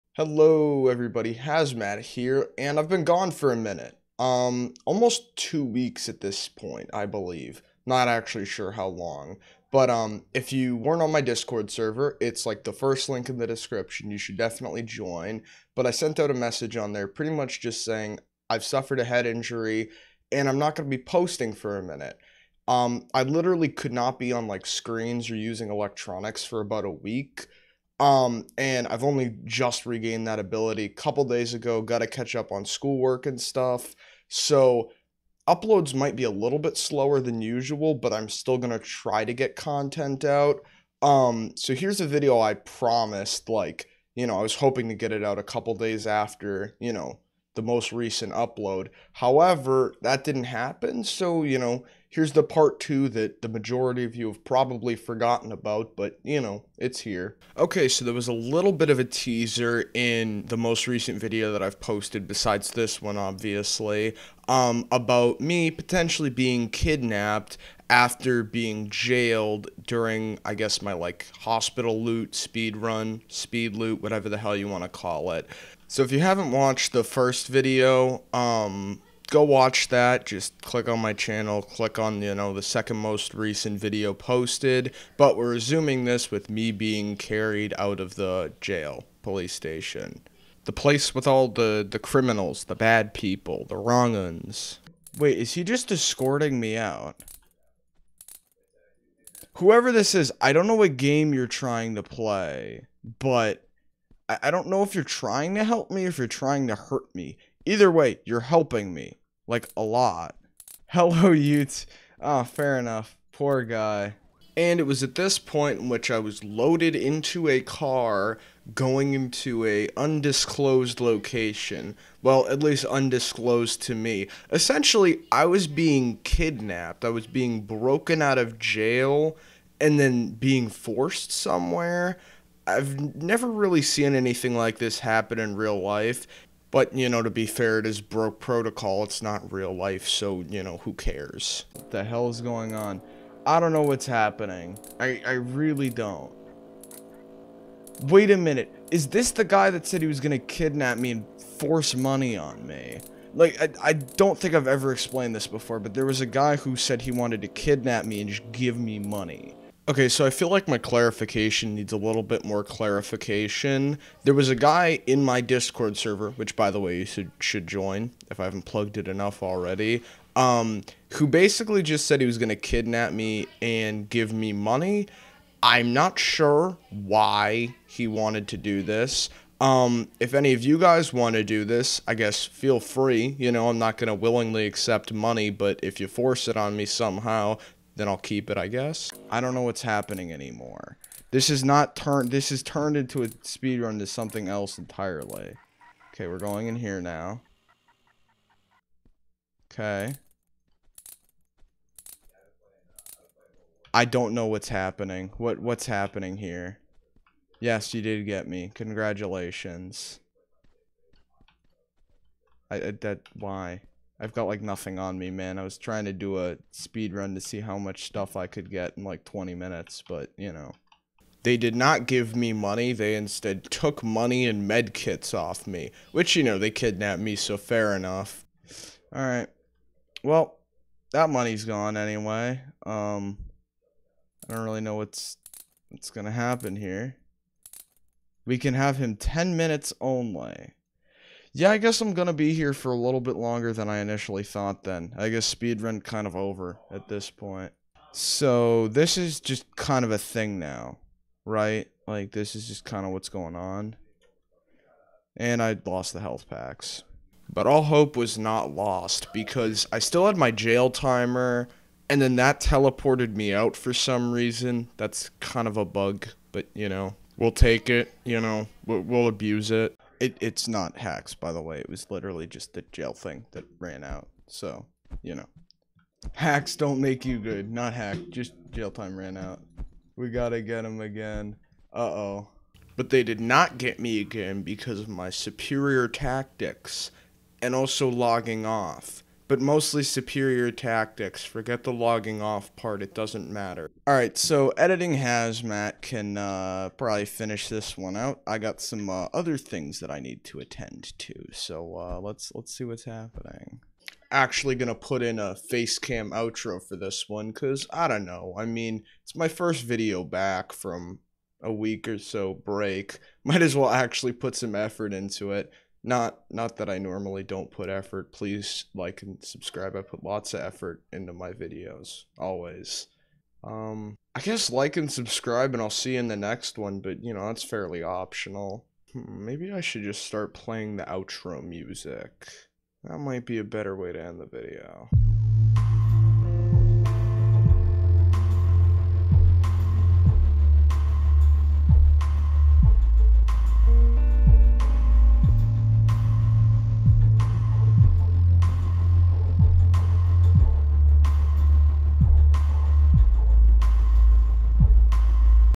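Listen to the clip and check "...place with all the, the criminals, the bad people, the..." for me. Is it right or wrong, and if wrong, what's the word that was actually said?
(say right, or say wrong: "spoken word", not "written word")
right.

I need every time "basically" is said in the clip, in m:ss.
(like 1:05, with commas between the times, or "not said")
2:51.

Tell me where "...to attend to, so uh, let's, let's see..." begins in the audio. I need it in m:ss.
5:00.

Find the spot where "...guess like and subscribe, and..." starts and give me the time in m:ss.
5:24.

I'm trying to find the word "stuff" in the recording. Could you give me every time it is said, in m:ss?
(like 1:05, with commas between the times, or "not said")
0:33, 3:38.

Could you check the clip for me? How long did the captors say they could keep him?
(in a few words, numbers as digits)
10 minutes.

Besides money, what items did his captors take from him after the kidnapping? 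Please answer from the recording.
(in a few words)
Med kits.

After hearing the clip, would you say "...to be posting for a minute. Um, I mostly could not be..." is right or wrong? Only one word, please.
wrong.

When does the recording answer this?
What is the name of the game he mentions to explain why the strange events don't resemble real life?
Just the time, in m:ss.
2:17.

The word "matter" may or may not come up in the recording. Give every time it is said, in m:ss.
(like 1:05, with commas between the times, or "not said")
4:53.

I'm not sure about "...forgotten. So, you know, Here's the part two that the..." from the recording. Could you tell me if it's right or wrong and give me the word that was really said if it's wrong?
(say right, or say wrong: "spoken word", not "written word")
wrong: "happen", not "forgotten".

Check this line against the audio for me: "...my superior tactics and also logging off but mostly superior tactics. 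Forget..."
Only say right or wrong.
right.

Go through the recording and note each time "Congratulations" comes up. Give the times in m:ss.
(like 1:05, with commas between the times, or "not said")
3:28.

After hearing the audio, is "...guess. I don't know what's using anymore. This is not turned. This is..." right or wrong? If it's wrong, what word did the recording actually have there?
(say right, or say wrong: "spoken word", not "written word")
wrong: "happening", not "using".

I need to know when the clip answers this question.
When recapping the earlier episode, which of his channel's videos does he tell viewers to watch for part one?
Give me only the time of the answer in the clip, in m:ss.
1:22.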